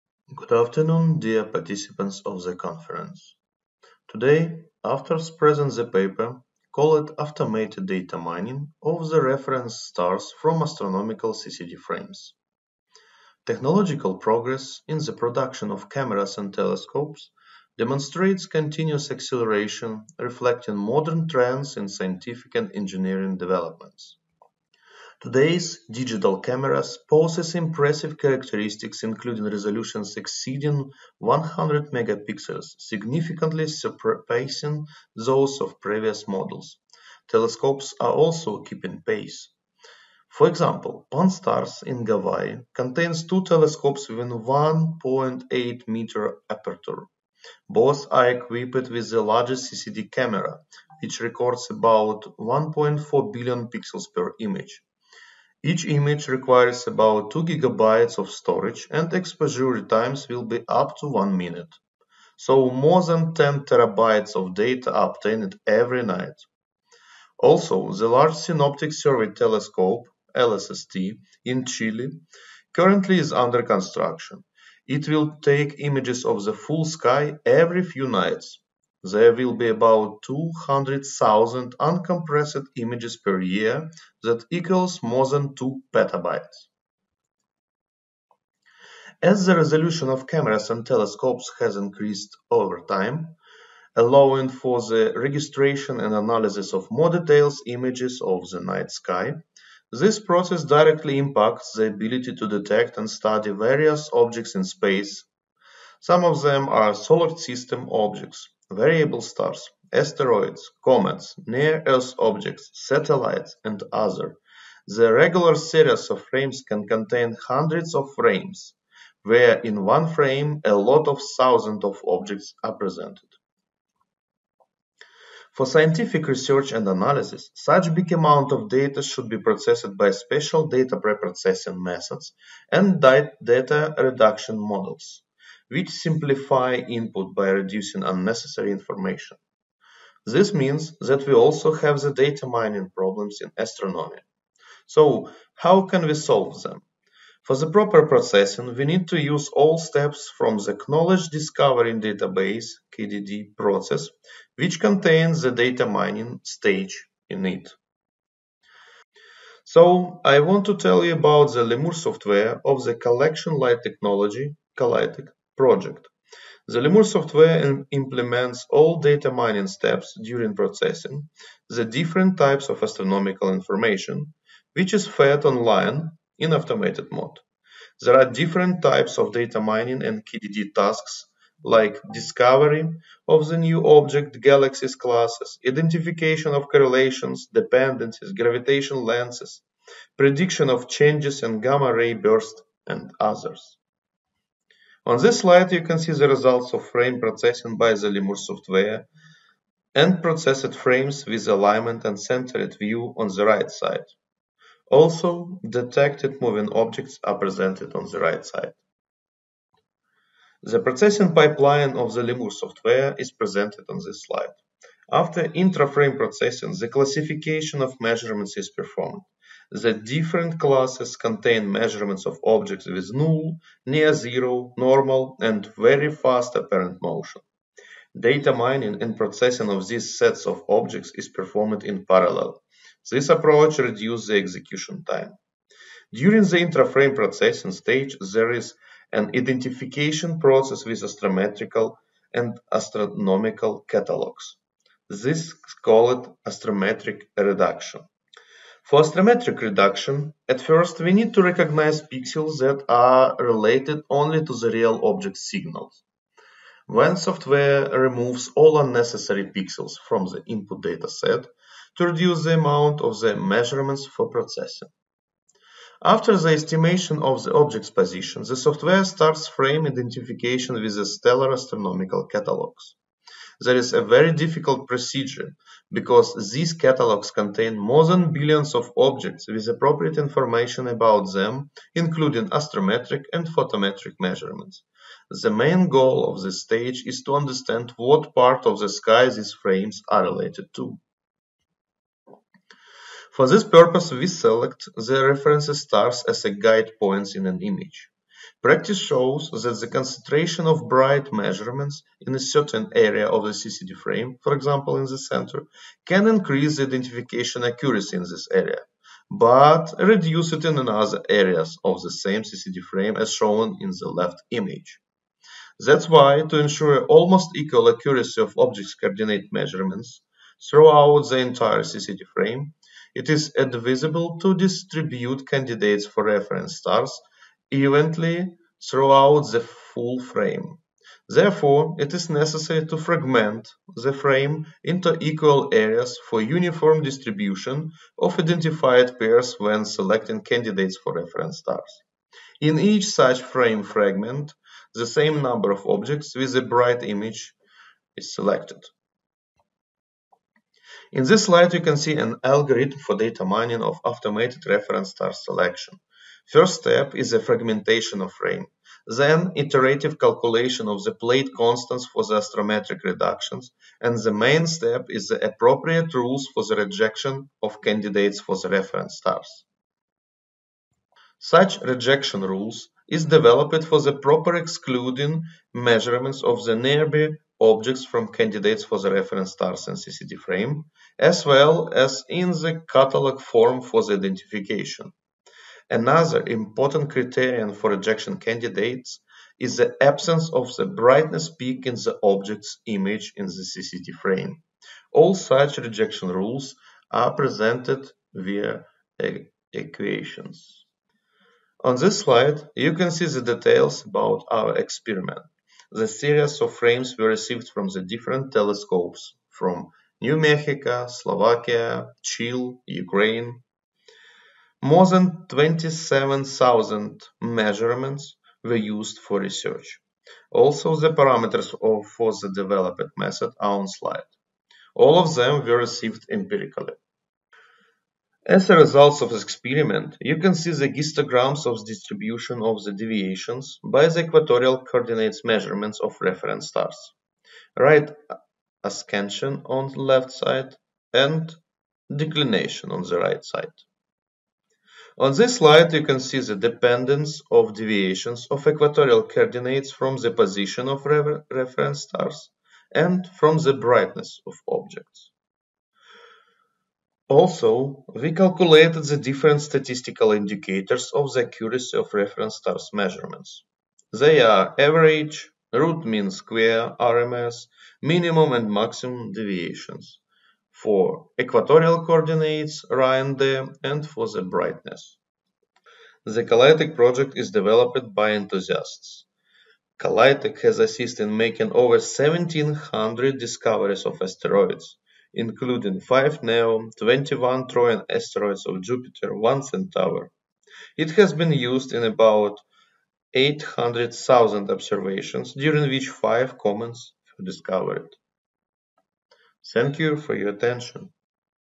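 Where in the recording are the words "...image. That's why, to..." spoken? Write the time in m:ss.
5:14.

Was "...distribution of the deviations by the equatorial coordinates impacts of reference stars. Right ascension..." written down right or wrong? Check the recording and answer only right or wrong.
wrong.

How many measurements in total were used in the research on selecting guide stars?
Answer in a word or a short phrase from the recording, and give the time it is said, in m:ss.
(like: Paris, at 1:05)
more than 27,000, at 6:54.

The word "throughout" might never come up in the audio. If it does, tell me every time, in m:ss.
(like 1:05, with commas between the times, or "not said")
5:20, 5:28.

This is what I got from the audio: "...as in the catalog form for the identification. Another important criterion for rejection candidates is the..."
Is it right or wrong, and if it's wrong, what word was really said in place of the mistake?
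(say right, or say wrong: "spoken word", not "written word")
right.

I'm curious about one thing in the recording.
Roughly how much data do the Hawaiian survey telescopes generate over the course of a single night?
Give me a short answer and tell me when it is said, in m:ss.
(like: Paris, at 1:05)
more than 10 terabytes, at 1:02.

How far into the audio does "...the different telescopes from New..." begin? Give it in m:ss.
6:47.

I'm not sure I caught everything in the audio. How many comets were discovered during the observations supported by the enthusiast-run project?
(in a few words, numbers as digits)
5.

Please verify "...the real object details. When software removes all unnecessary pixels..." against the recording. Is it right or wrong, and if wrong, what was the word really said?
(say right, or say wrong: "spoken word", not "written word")
wrong: "signals", not "details".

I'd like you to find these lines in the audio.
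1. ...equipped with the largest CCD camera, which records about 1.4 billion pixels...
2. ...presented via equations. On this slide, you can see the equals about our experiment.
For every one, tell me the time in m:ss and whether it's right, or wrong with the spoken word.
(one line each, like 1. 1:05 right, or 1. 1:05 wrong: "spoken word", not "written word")
1. 0:48 right
2. 6:37 wrong: "details", not "equals".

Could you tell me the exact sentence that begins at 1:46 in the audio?
Some of them are solar system objects, variable stars, asteroids, comets, near-Earth objects, satellites, and other.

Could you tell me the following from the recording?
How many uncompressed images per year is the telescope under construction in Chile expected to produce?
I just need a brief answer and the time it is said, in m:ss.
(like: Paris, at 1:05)
200,000, at 1:20.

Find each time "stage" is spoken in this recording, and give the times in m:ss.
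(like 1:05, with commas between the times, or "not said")
2:36, 3:57, 4:46.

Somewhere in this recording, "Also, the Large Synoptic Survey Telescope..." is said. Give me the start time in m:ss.
1:07.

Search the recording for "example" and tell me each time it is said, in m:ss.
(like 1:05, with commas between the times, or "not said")
0:40, 5:04.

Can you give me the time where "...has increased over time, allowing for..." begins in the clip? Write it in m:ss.
1:31.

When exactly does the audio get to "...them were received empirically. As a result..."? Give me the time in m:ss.
7:05.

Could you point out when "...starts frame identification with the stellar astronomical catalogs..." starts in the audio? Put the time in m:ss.
4:29.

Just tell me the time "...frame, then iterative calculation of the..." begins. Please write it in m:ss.
5:58.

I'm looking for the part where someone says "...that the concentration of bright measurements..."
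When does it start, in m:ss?
4:59.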